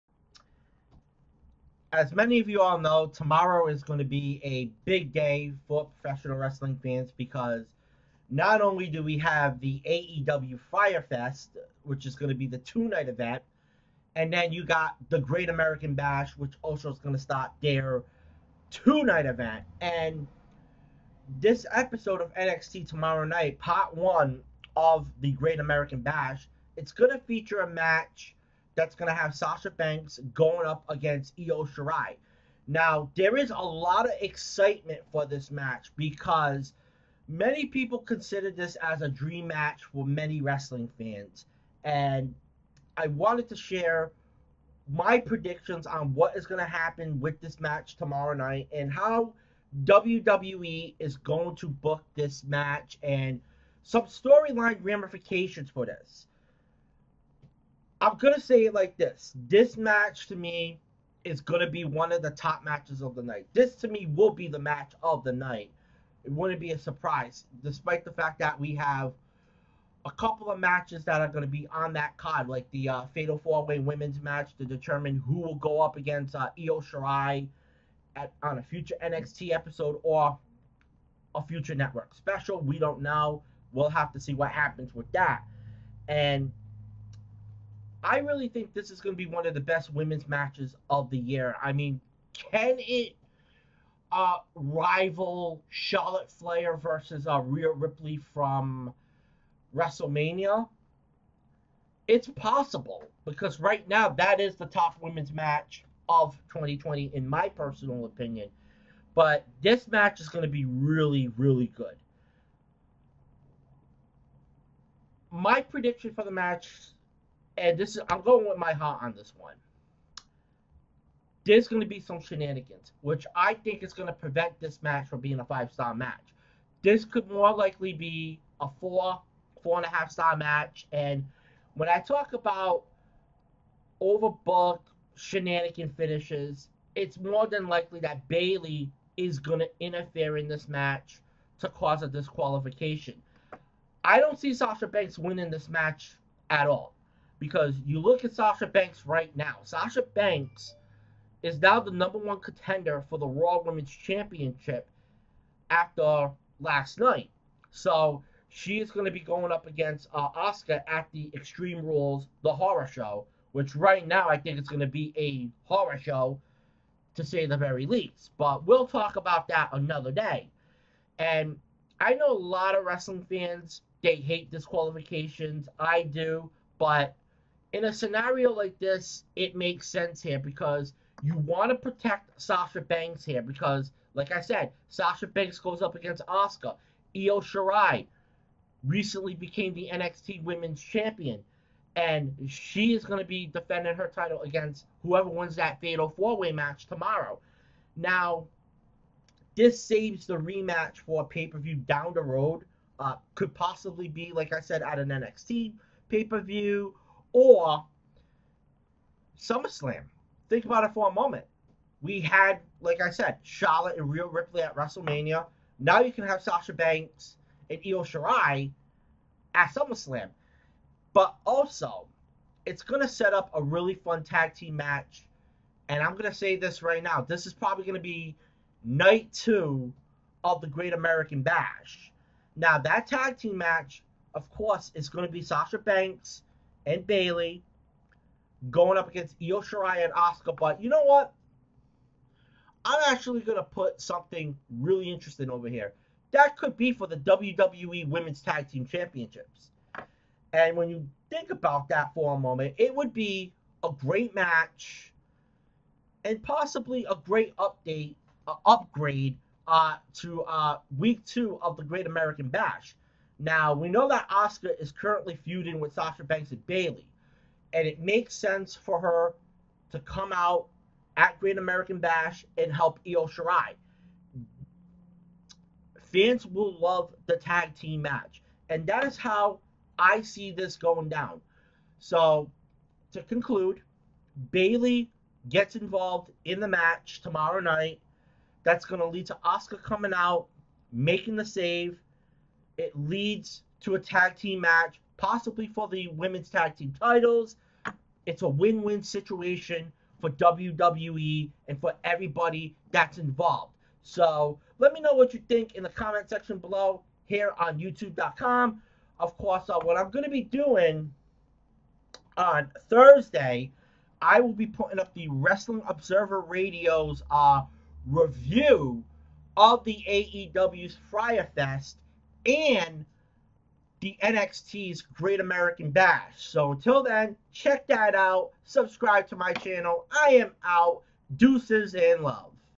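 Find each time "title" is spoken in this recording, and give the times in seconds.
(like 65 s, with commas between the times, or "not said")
194 s, 296 s.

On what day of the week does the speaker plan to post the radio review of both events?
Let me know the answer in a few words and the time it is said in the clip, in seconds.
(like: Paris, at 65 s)
Thursday, at 312 s.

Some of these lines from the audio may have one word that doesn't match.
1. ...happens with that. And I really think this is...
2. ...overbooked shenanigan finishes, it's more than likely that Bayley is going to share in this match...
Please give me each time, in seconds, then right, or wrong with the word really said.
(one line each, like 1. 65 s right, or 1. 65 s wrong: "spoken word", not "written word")
1. 84 s right
2. 134 s wrong: "interfere", not "share".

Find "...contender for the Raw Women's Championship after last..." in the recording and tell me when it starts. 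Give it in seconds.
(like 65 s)
152 s.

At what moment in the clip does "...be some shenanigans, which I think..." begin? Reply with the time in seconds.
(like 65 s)
121 s.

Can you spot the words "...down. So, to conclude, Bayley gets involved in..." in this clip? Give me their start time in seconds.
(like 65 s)
281 s.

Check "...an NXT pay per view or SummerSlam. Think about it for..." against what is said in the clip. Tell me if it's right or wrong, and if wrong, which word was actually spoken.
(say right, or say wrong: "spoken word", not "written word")
right.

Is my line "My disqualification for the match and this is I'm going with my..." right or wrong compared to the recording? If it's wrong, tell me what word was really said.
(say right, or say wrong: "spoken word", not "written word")
wrong: "prediction", not "disqualification".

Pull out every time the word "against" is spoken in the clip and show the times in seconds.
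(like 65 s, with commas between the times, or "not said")
30 s, 75 s, 159 s, 185 s, 194 s, 239 s.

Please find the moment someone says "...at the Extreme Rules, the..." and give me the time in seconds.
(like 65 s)
160 s.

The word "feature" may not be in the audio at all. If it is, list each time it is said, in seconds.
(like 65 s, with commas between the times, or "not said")
27 s.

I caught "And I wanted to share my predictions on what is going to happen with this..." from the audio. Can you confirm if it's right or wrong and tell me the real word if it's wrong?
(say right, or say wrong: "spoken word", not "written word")
right.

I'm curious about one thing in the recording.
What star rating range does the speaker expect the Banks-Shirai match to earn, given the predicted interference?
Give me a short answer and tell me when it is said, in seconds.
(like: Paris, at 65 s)
4 to 4.5 stars, at 128 s.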